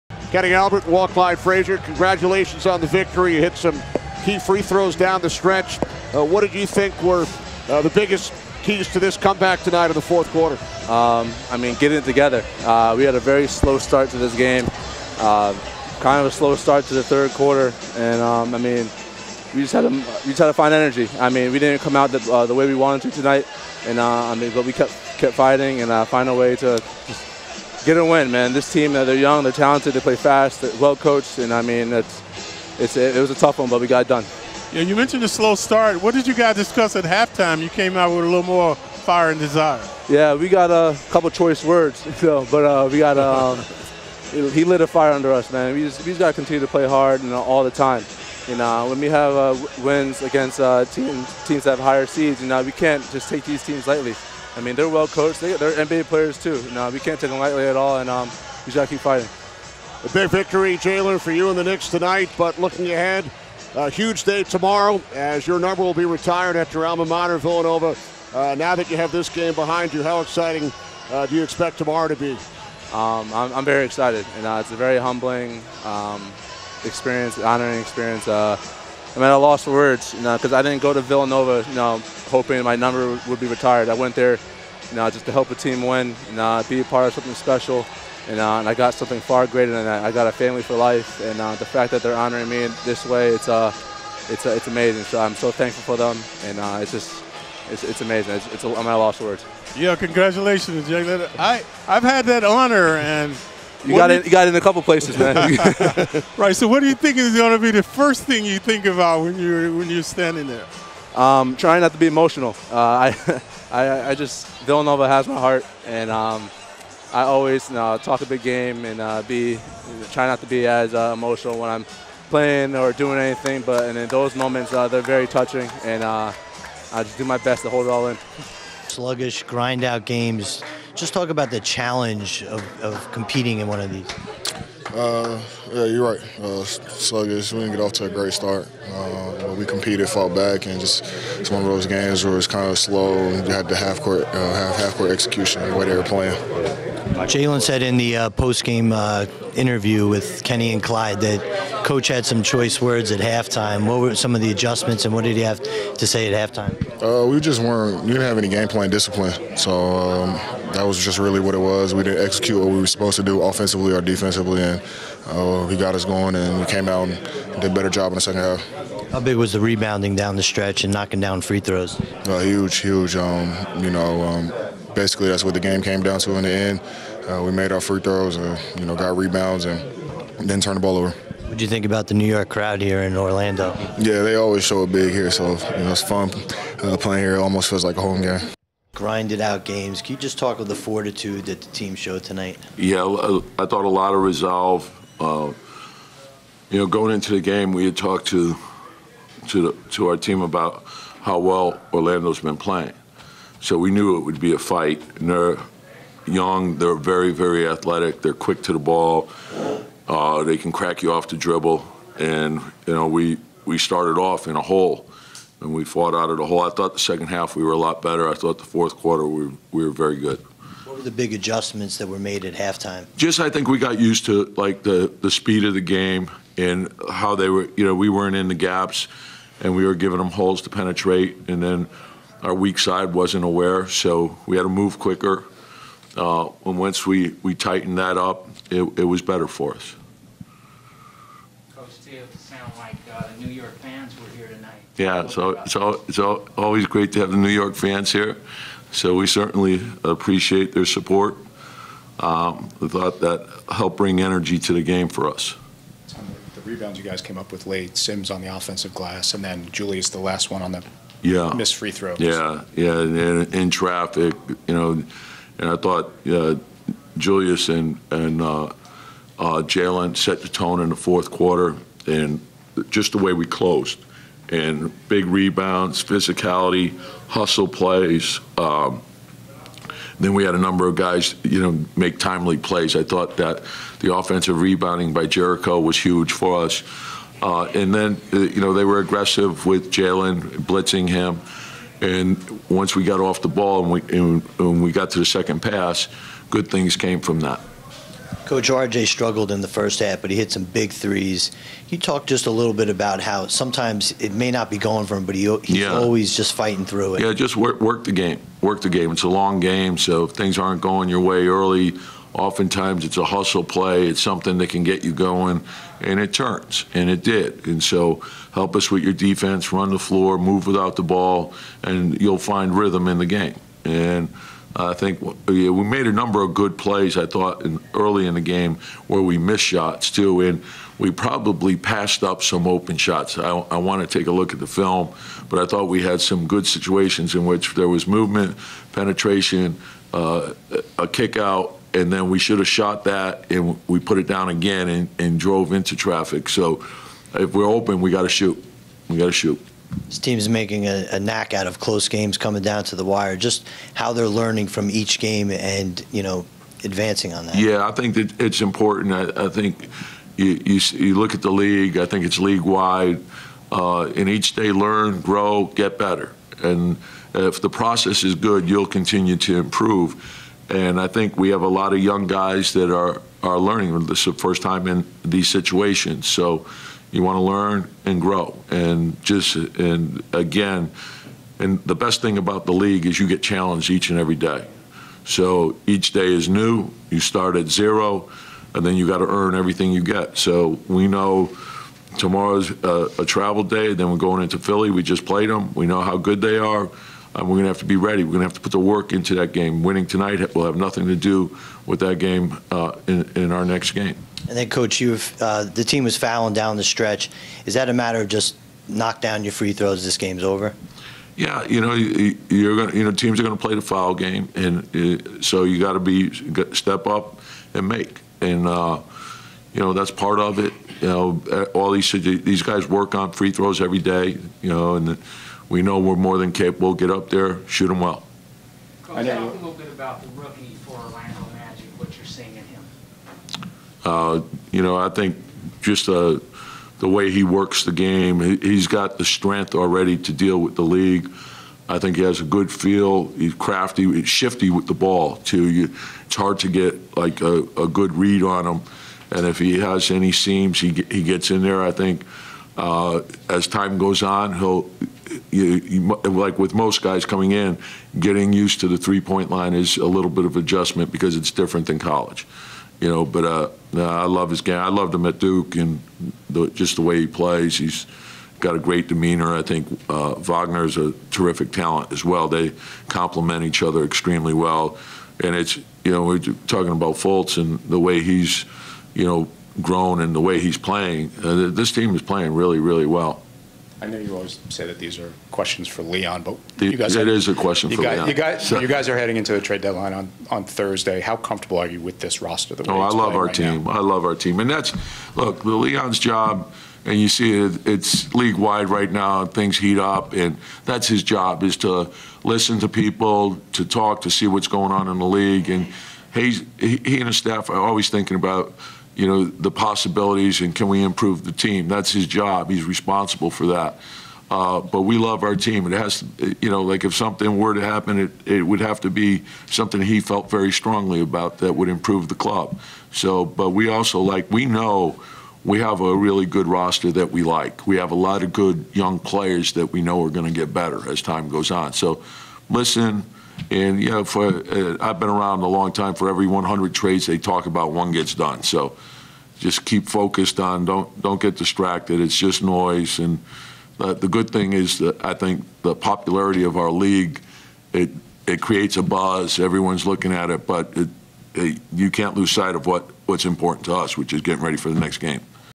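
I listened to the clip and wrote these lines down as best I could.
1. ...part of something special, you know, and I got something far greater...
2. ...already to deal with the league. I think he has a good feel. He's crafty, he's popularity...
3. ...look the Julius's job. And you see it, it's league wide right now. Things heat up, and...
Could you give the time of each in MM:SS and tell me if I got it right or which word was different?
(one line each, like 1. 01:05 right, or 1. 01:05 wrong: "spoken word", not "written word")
1. 01:26 right
2. 07:19 wrong: "shifty", not "popularity"
3. 08:15 wrong: "Leon", not "Julius".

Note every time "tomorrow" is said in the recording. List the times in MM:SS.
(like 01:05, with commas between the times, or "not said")
01:04, 01:11, 06:32.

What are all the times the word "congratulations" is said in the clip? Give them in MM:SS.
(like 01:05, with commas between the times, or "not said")
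00:01, 01:39.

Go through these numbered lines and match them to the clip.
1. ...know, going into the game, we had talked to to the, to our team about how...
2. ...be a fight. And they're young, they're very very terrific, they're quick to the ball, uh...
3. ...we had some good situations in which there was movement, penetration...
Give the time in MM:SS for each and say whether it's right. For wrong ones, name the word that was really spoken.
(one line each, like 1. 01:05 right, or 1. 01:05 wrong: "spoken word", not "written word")
1. 03:16 right
2. 03:24 wrong: "athletic", not "terrific"
3. 05:35 right.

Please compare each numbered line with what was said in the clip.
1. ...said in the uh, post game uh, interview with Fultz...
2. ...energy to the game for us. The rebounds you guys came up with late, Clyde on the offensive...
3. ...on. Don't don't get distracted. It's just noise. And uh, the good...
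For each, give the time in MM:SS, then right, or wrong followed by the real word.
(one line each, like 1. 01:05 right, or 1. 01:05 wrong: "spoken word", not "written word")
1. 02:27 wrong: "Kenny", not "Fultz"
2. 04:14 wrong: "Sims", not "Clyde"
3. 09:00 right.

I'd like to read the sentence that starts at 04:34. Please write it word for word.
And big rebounds, physicality, hustle plays.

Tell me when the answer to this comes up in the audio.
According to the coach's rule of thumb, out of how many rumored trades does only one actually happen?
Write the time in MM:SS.
08:56.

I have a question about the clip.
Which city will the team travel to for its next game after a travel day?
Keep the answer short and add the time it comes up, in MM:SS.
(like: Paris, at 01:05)
Philly, at 06:34.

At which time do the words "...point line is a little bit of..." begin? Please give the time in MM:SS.
07:39.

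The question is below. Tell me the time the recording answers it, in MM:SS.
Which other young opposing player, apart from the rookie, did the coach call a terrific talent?
07:50.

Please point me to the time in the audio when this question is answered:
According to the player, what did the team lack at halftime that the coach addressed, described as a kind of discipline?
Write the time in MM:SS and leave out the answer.
02:38.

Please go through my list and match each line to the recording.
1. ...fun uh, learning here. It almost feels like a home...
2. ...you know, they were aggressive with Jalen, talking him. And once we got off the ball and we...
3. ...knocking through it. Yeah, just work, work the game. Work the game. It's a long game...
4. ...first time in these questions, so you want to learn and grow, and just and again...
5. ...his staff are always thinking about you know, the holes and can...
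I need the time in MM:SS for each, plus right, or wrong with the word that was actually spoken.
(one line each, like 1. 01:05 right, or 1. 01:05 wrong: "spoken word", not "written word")
1. 03:06 wrong: "playing", not "learning"
2. 04:48 wrong: "blitzing", not "talking"
3. 05:06 wrong: "fighting", not "knocking"
4. 06:14 wrong: "situations", not "questions"
5. 08:27 wrong: "possibilities", not "holes".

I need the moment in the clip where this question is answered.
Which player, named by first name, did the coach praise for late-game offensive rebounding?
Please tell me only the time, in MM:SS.
04:45.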